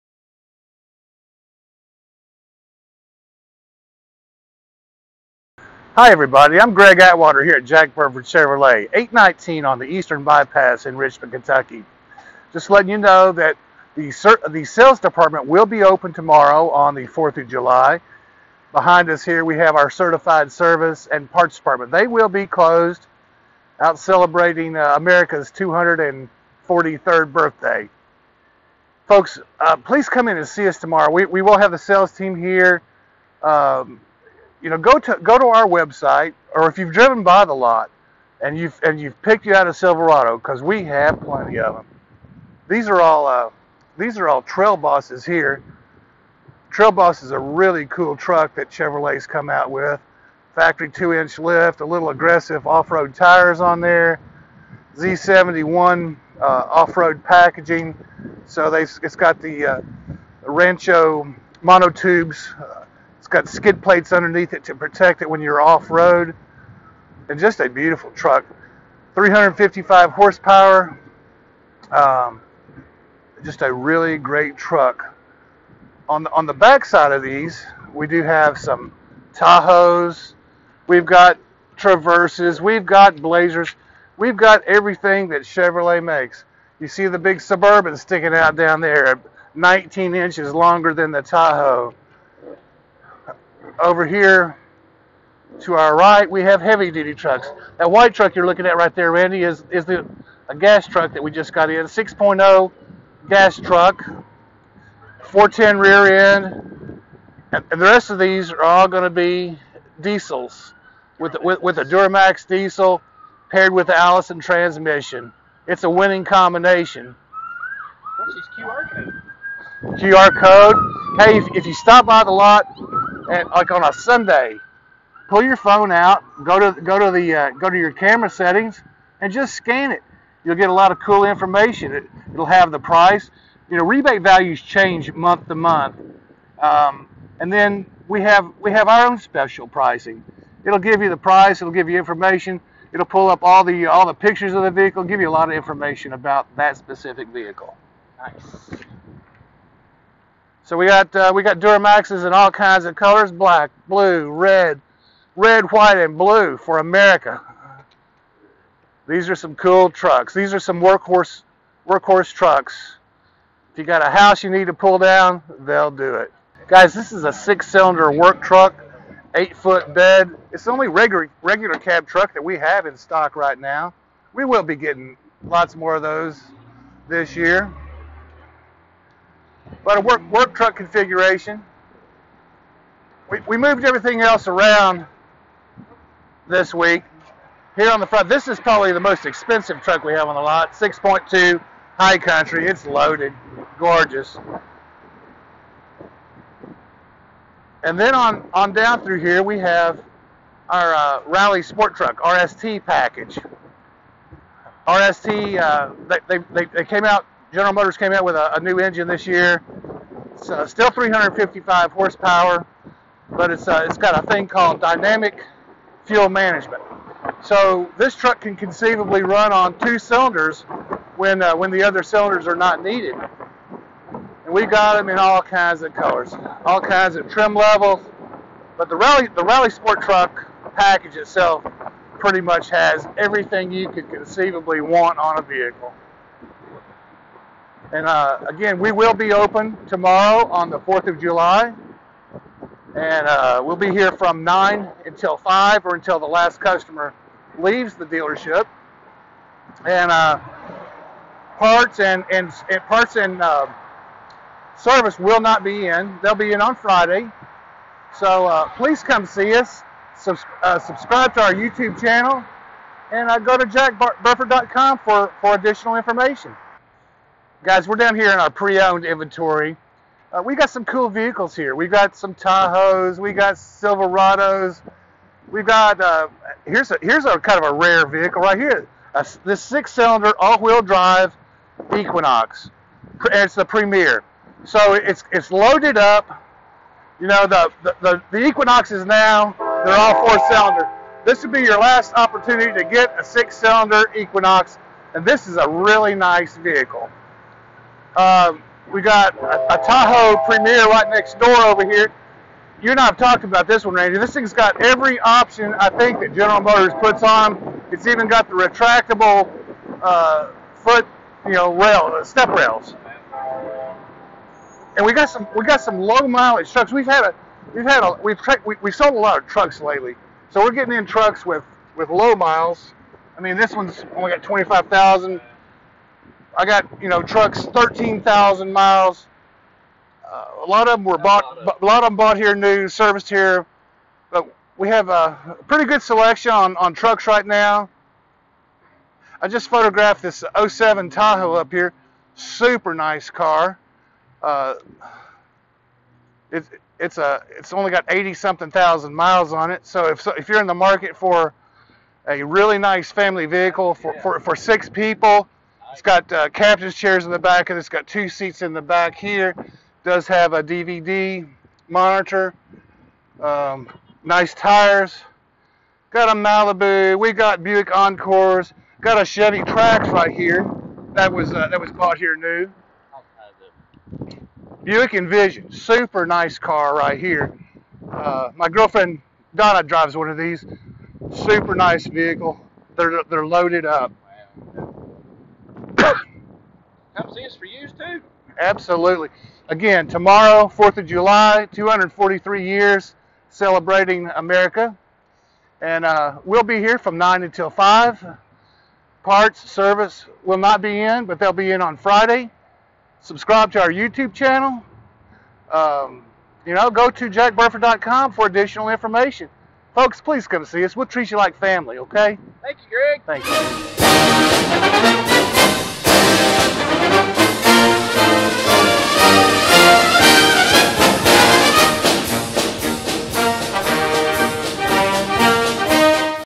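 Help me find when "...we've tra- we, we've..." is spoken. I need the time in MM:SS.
05:18.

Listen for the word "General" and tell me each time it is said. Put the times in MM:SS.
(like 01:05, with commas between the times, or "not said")
03:27, 05:06.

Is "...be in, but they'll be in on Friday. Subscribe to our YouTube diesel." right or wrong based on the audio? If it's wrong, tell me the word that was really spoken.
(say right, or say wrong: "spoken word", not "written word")
wrong: "channel", not "diesel".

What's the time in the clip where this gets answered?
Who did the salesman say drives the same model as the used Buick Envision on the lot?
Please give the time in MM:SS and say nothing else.
06:19.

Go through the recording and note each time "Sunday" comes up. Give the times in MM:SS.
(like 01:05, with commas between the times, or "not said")
02:03.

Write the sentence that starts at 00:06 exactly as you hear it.
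I'm Greg Atwater here at Jack Burford Chevrolet, 819 on the Eastern Bypass in Richmond, Kentucky.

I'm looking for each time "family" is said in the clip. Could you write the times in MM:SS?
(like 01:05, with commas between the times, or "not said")
05:53, 06:51.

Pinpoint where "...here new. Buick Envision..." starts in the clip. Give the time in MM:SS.
06:12.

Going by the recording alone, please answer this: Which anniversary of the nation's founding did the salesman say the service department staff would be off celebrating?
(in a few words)
243rd.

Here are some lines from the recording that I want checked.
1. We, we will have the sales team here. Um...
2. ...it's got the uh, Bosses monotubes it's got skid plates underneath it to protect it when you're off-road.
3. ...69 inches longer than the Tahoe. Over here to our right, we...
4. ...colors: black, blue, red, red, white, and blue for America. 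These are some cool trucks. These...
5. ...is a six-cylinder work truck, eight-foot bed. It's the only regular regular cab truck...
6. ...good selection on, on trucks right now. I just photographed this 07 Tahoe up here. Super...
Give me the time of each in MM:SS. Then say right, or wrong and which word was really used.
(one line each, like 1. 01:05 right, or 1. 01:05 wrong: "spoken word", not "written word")
1. 00:31 right
2. 00:58 wrong: "Rancho", not "Bosses"
3. 01:29 wrong: "19", not "69"
4. 02:32 right
5. 02:47 right
6. 05:35 right.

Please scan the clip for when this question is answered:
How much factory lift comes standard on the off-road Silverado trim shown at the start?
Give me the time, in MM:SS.
00:50.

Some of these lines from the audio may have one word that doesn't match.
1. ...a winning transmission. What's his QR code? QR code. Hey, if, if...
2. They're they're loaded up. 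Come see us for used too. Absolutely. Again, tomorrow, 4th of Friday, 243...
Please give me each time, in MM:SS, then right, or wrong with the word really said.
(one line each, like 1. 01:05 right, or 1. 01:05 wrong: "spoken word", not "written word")
1. 01:55 wrong: "combination", not "transmission"
2. 06:22 wrong: "July", not "Friday".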